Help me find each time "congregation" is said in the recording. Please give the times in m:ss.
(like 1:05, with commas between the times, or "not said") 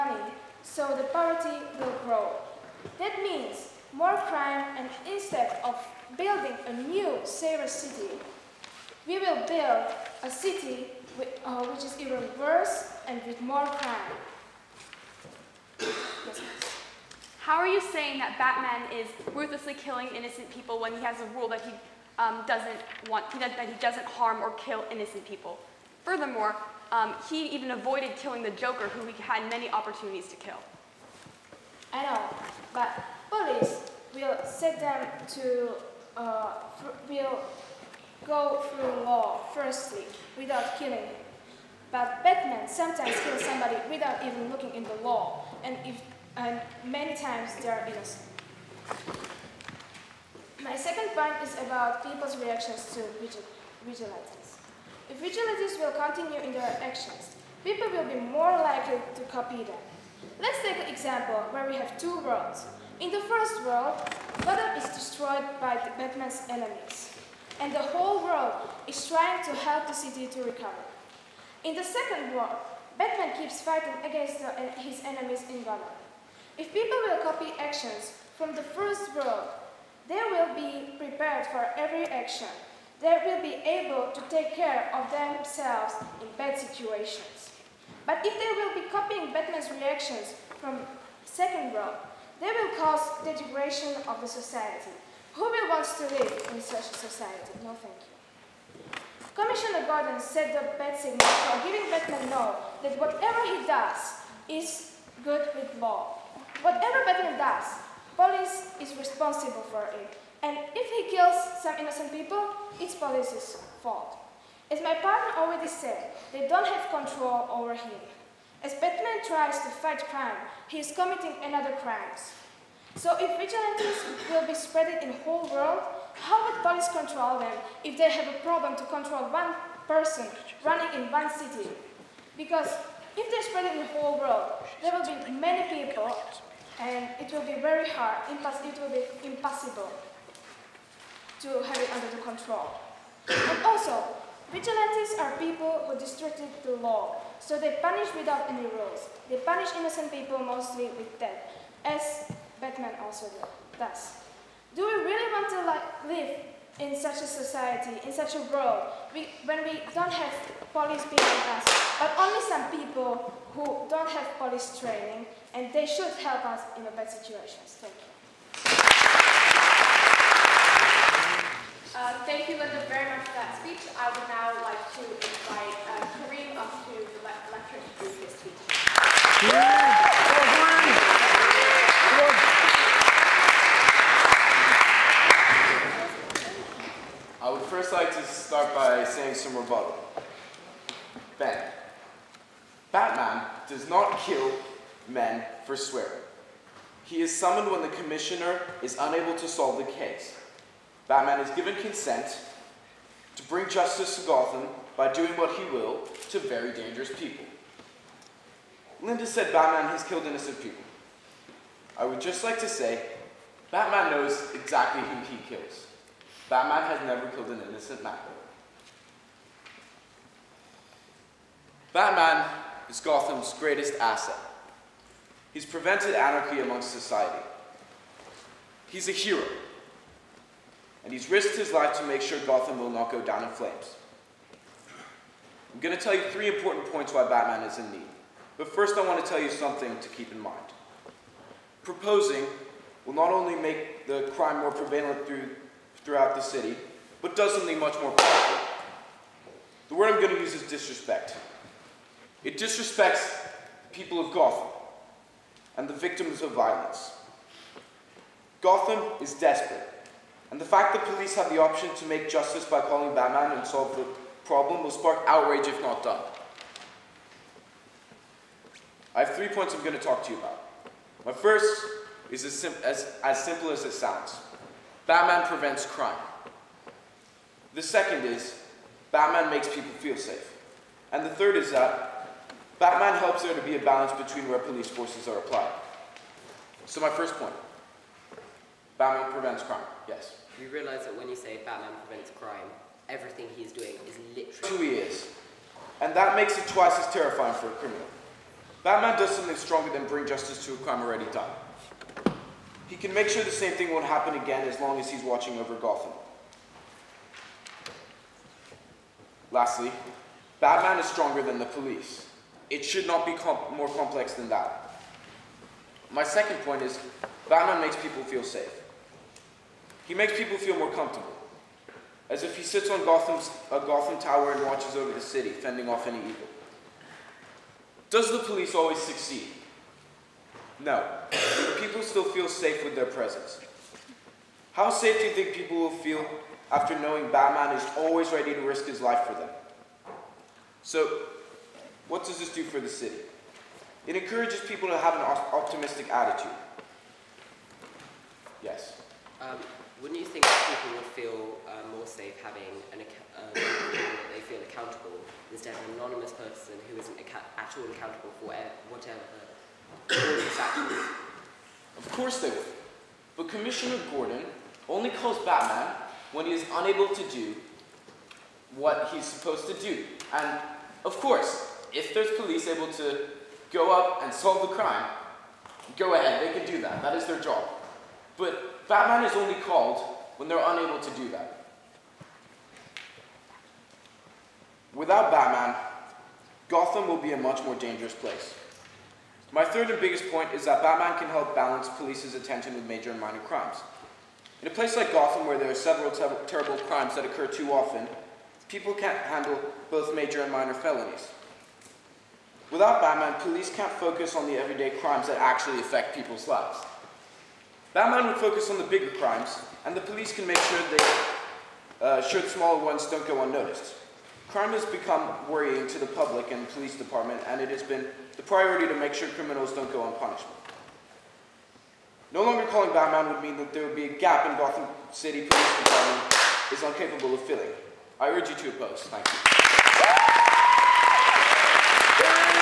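not said.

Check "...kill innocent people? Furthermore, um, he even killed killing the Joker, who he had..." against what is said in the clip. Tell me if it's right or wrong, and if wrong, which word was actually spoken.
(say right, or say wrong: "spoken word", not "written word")
wrong: "avoided", not "killed".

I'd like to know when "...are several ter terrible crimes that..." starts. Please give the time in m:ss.
6:35.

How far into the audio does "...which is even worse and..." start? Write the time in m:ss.
0:11.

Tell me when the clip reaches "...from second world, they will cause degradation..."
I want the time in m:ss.
1:30.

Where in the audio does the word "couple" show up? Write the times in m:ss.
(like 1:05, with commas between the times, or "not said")
not said.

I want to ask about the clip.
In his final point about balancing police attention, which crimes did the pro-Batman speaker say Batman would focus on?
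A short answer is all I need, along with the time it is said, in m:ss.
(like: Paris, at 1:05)
the bigger crimes, at 6:48.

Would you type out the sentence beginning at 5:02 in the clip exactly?
He can make sure the same thing won't happen again as long as he's watching over Gotham.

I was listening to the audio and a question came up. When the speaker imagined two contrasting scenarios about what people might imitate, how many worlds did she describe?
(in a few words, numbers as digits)
2.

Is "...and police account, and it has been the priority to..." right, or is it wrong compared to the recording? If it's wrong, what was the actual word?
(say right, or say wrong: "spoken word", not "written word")
wrong: "department", not "account".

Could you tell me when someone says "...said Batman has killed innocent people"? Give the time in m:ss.
3:29.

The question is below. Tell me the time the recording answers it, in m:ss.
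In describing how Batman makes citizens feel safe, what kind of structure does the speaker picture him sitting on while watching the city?
5:23.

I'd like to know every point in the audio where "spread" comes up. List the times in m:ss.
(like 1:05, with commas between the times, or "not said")
2:04, 2:13.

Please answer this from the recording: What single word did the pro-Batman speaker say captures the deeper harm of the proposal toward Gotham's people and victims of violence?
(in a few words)
disrespect.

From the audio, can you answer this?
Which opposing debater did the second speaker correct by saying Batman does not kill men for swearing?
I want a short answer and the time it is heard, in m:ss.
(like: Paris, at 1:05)
Ben, at 3:11.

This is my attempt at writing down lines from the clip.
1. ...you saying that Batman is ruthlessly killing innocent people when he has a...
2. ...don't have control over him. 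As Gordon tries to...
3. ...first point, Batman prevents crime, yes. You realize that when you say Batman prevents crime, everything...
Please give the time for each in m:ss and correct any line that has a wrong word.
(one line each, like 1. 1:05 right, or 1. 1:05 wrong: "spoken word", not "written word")
1. 0:17 right
2. 1:56 wrong: "Batman", not "Gordon"
3. 4:47 right.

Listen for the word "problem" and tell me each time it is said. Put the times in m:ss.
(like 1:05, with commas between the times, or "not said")
2:08, 4:24.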